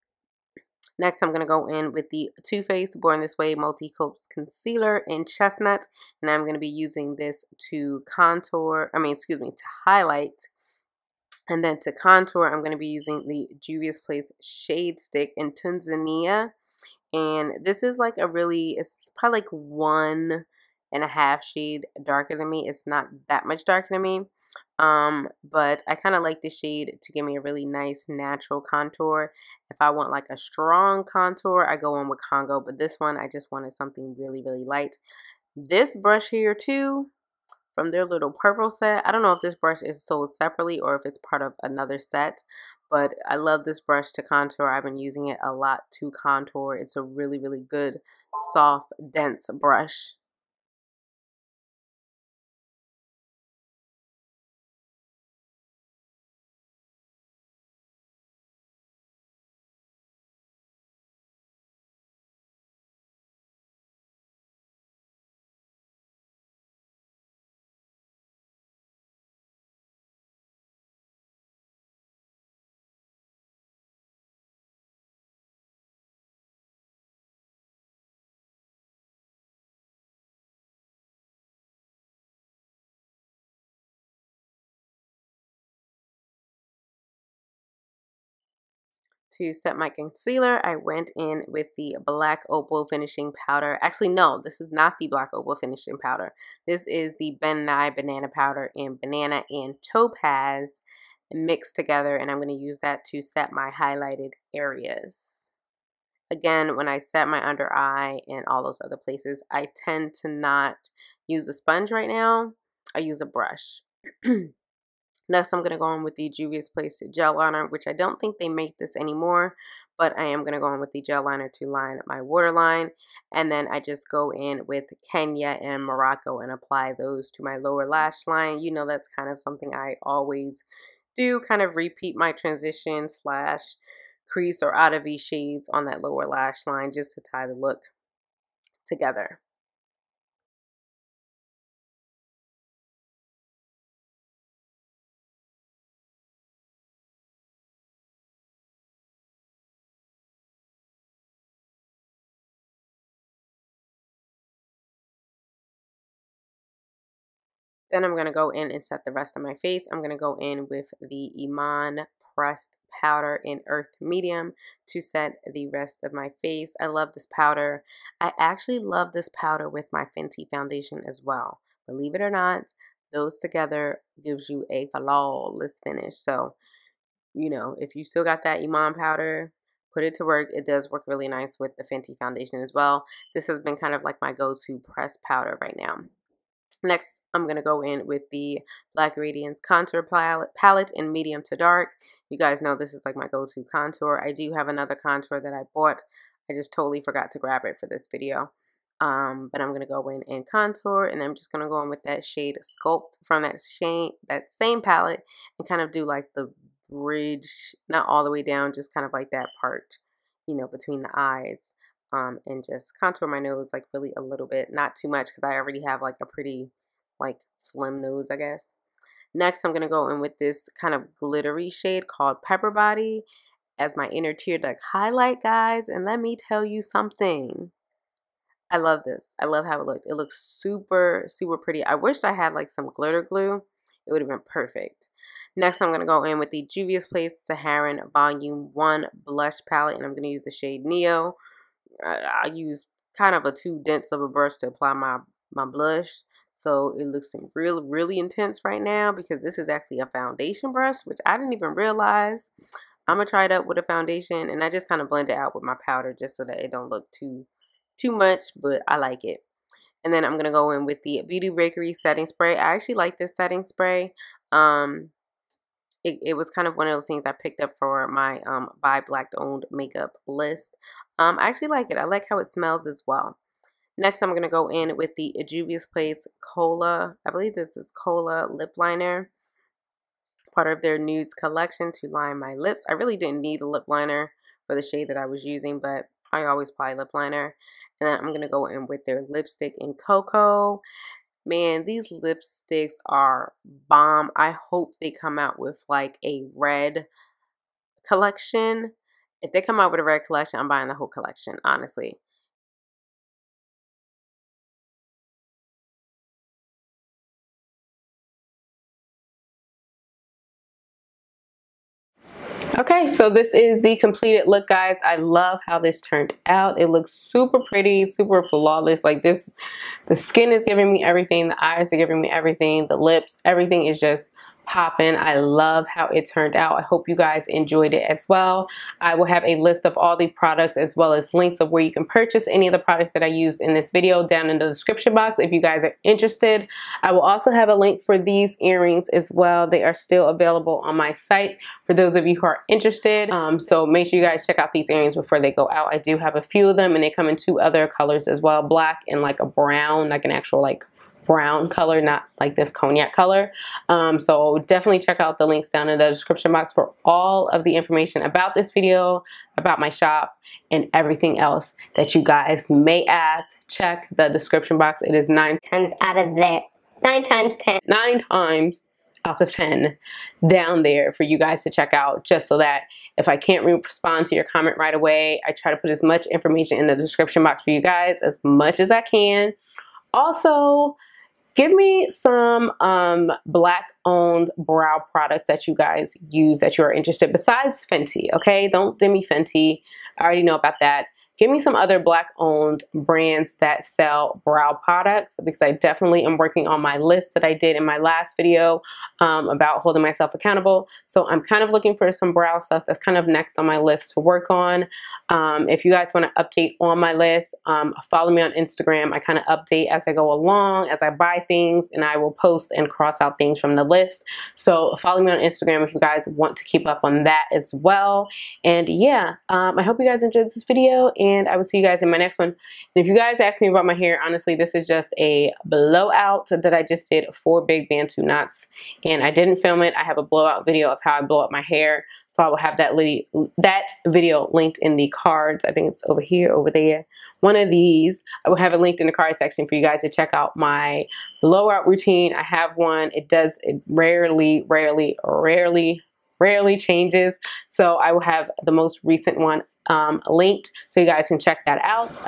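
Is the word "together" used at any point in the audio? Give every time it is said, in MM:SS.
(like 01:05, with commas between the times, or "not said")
01:41, 02:18, 02:53.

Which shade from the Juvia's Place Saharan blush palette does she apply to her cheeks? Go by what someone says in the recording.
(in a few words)
Neo.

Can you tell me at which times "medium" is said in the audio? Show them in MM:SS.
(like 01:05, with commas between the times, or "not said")
02:43, 03:11.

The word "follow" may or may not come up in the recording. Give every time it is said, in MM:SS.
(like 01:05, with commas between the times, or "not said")
06:48, 06:54.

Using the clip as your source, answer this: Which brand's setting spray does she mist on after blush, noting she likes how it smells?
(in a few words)
Beauty Bakery.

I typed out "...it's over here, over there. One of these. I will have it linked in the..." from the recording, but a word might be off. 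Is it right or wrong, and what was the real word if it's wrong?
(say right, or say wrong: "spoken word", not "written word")
right.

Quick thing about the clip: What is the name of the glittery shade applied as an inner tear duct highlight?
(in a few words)
Pepper Body.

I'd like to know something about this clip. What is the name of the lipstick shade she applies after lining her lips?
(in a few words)
Cocoa.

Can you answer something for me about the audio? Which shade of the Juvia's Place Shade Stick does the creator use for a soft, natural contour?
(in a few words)
Tanzania.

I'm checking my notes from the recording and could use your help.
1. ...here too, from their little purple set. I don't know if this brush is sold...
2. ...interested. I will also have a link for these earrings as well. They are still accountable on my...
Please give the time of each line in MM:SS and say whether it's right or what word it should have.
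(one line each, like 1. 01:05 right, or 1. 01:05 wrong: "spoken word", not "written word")
1. 00:36 right
2. 05:36 wrong: "available", not "accountable".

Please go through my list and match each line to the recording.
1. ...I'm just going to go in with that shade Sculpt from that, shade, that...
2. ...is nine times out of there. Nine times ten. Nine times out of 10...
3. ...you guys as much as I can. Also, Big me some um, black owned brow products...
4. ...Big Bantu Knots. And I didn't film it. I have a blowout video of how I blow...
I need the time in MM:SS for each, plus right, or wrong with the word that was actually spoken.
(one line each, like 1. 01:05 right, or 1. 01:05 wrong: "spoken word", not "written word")
1. 03:21 right
2. 06:05 right
3. 06:17 wrong: "Give", not "Big"
4. 07:07 right.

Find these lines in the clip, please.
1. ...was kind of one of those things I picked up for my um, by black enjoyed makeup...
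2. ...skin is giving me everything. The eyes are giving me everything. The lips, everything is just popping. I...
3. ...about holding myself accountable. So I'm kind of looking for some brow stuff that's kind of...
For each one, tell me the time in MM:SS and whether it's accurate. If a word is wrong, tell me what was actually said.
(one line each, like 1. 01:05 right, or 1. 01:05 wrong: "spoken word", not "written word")
1. 04:26 wrong: "owned", not "enjoyed"
2. 05:20 right
3. 06:39 right.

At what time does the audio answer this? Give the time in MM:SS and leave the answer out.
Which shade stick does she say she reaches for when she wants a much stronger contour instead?
00:32.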